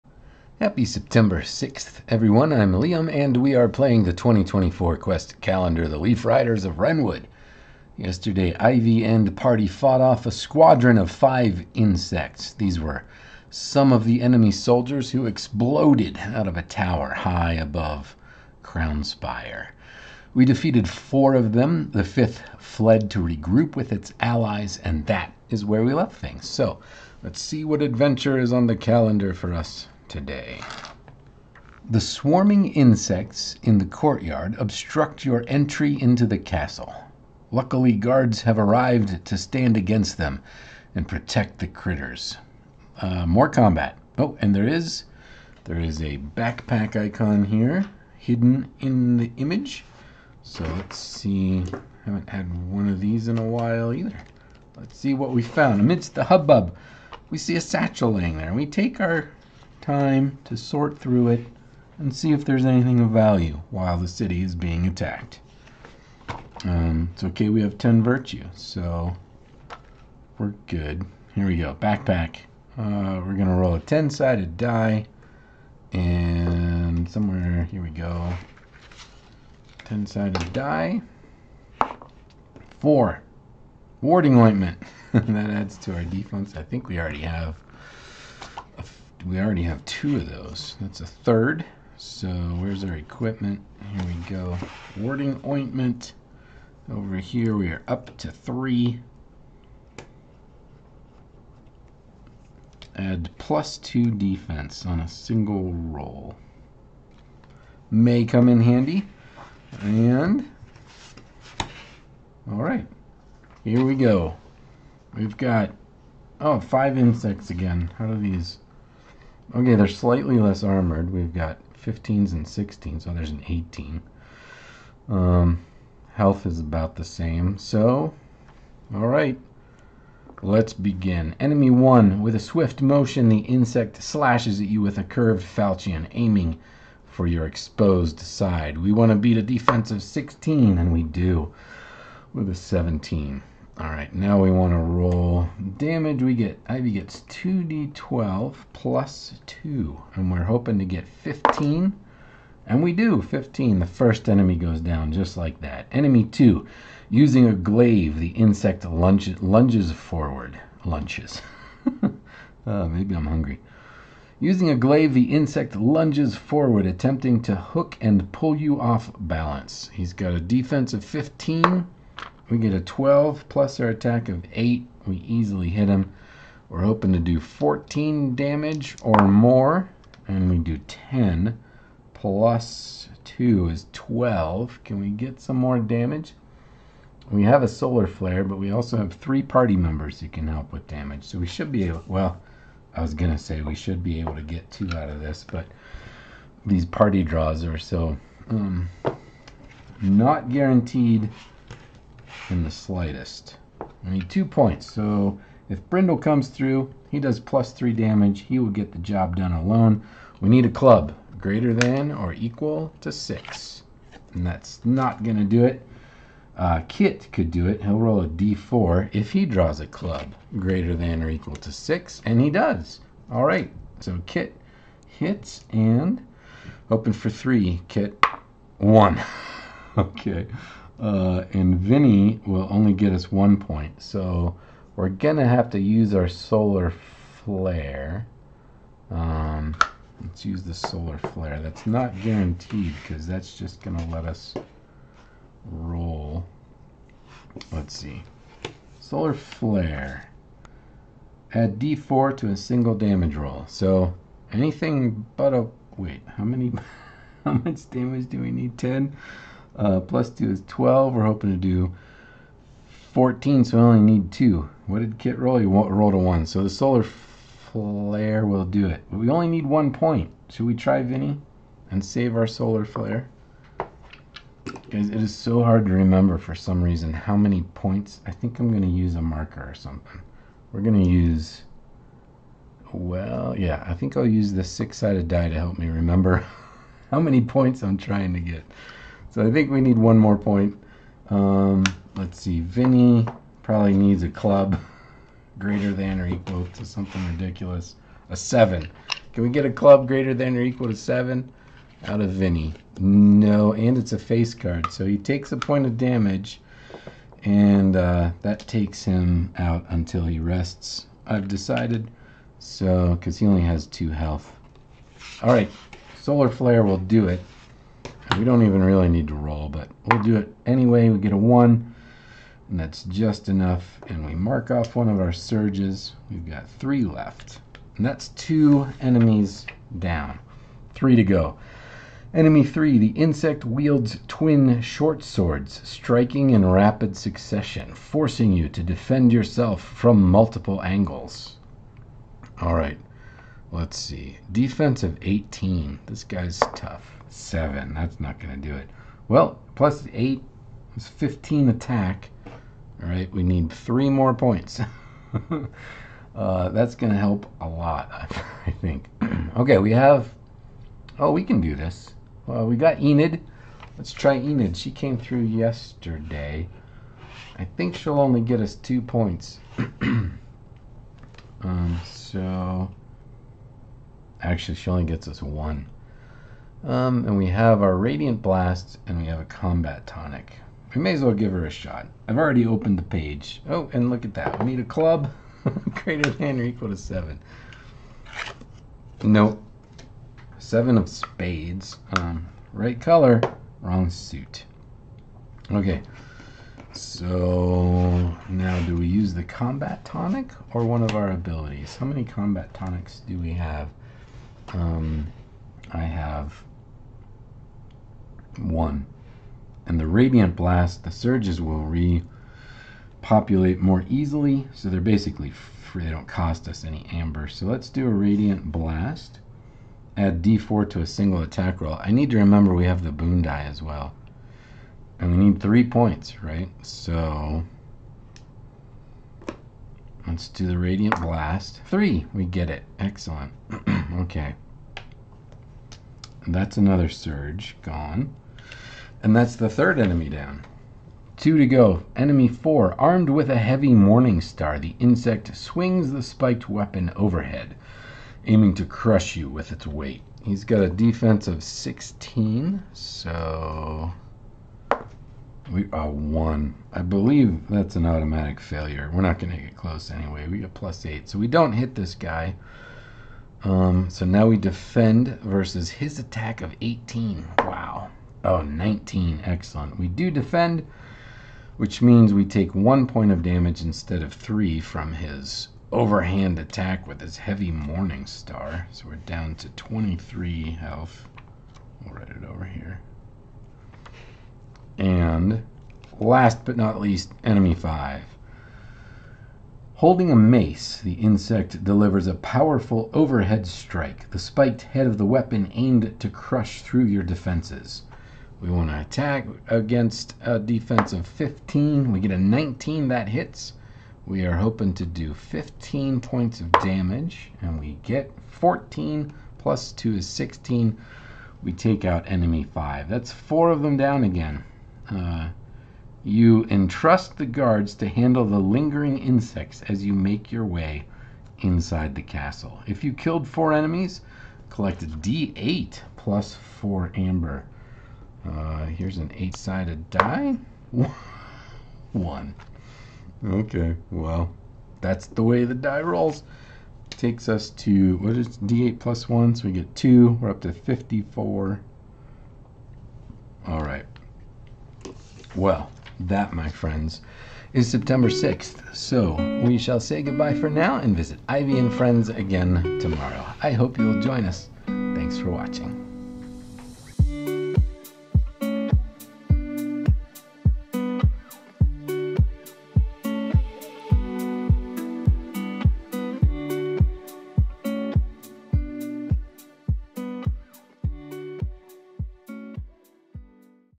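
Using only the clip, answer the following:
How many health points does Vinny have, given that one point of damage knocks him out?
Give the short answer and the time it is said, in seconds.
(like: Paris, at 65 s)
2, at 313 s.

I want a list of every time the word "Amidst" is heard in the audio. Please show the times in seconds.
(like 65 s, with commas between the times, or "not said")
55 s.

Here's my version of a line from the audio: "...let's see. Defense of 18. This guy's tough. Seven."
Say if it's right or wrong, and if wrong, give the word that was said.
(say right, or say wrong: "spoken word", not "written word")
right.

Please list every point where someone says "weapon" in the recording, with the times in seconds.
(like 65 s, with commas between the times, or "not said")
446 s, 495 s.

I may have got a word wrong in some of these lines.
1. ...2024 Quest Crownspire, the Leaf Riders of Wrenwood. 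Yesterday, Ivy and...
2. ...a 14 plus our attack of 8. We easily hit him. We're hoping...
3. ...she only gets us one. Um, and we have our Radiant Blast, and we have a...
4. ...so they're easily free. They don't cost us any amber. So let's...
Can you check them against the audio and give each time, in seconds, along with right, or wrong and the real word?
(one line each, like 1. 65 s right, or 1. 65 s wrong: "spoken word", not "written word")
1. 4 s wrong: "Calendar", not "Crownspire"
2. 172 s wrong: "12", not "14"
3. 374 s right
4. 414 s wrong: "basically", not "easily".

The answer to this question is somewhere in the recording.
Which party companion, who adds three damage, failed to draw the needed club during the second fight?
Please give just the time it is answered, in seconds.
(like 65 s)
205 s.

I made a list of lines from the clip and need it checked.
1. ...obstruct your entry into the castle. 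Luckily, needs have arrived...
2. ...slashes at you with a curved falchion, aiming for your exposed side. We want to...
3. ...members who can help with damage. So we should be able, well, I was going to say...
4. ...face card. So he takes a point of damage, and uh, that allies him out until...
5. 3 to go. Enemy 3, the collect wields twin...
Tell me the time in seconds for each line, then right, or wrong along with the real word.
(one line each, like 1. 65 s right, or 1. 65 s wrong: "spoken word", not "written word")
1. 34 s wrong: "guards", not "needs"
2. 134 s right
3. 189 s right
4. 304 s wrong: "takes", not "allies"
5. 330 s wrong: "insect", not "collect".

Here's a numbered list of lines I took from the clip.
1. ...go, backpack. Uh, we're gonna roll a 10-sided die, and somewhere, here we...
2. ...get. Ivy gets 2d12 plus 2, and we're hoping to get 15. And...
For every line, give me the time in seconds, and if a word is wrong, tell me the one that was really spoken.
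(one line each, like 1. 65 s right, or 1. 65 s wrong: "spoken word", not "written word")
1. 71 s right
2. 146 s right.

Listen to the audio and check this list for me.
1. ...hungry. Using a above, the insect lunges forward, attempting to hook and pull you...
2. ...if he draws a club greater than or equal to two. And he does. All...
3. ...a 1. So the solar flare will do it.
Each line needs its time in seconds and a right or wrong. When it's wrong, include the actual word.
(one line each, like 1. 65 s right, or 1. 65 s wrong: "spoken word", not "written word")
1. 163 s wrong: "glaive", not "above"
2. 219 s wrong: "six", not "two"
3. 266 s right.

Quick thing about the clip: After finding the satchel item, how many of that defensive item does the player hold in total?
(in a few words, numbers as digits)
3.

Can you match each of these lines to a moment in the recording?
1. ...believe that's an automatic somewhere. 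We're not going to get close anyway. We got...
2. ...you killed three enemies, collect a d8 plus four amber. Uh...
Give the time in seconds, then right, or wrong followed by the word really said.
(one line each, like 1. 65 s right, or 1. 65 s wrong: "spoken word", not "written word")
1. 457 s wrong: "failure", not "somewhere"
2. 523 s wrong: "four", not "three".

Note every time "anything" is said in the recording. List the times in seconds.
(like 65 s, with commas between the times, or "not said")
62 s, 254 s.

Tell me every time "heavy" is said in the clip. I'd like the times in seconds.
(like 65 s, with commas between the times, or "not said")
443 s, 477 s.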